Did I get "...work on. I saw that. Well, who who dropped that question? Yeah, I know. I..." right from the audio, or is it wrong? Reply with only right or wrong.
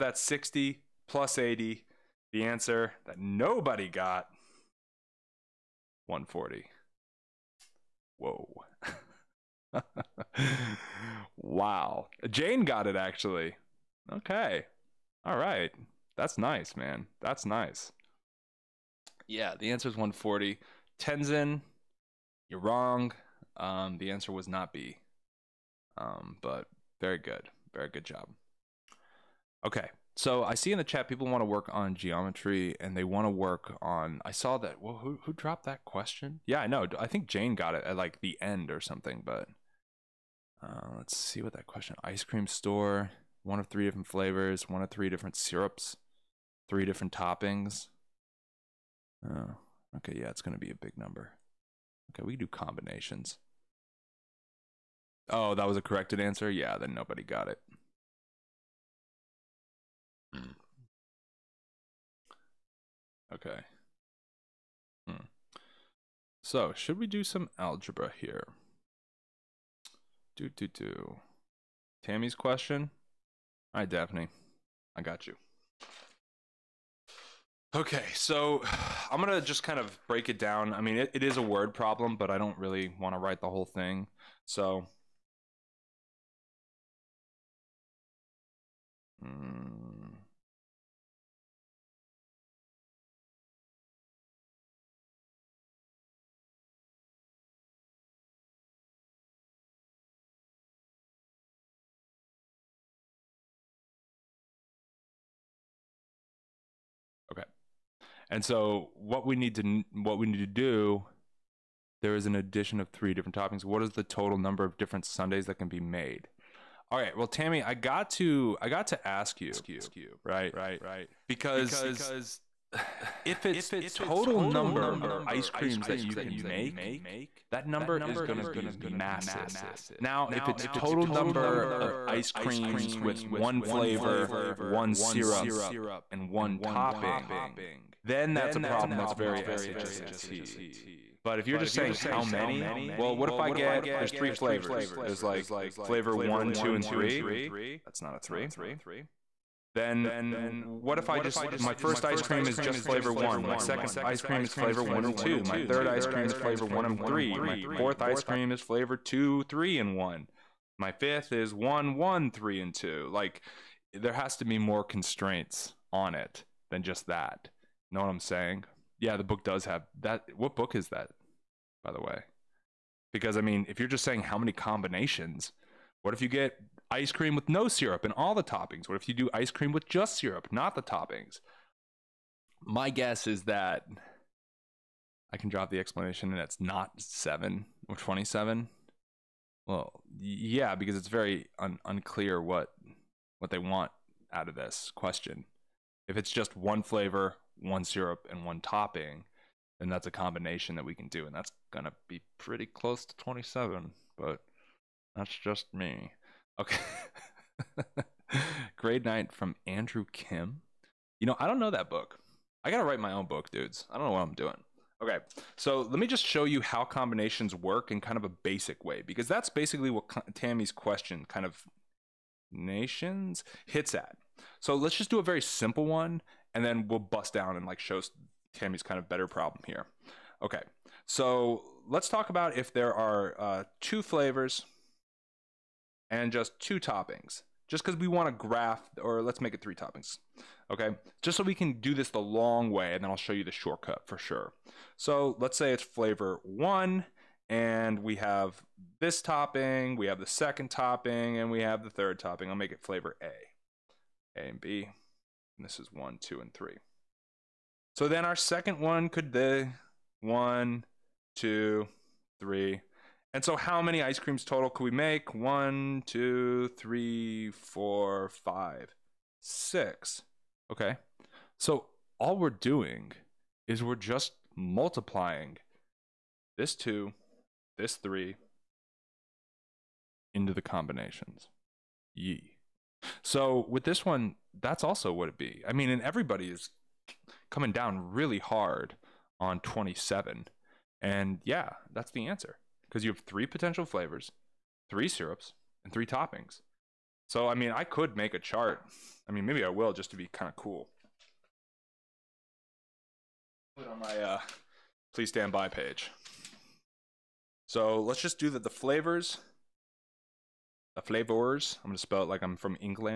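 right.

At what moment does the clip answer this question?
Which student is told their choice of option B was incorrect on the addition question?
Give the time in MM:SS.
00:20.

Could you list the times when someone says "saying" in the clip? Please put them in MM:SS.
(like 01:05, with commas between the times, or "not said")
02:21, 02:48, 02:54.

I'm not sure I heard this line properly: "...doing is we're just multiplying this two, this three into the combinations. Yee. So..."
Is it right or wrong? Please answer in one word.
right.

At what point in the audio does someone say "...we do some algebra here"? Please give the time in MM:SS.
01:06.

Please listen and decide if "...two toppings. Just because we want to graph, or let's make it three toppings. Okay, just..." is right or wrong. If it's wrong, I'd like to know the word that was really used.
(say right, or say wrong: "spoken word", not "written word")
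right.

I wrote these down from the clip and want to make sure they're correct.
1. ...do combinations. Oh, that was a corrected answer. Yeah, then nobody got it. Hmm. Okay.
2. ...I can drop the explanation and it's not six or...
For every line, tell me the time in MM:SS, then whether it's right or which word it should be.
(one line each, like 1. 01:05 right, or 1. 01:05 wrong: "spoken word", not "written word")
1. 00:52 right
2. 03:05 wrong: "seven", not "six".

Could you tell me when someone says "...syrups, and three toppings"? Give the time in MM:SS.
04:55.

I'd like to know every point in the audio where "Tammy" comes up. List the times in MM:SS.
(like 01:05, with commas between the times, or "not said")
01:12, 01:57, 03:40, 03:48.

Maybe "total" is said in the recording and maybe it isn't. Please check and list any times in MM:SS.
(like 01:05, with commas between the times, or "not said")
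01:54, 02:03, 02:10, 04:24.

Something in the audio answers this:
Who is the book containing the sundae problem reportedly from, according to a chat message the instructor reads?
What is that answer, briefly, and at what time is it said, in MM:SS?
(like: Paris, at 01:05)
Andrew Kim, at 03:29.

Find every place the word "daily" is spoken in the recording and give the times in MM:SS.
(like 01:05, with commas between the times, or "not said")
not said.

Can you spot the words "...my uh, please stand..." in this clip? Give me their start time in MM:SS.
05:03.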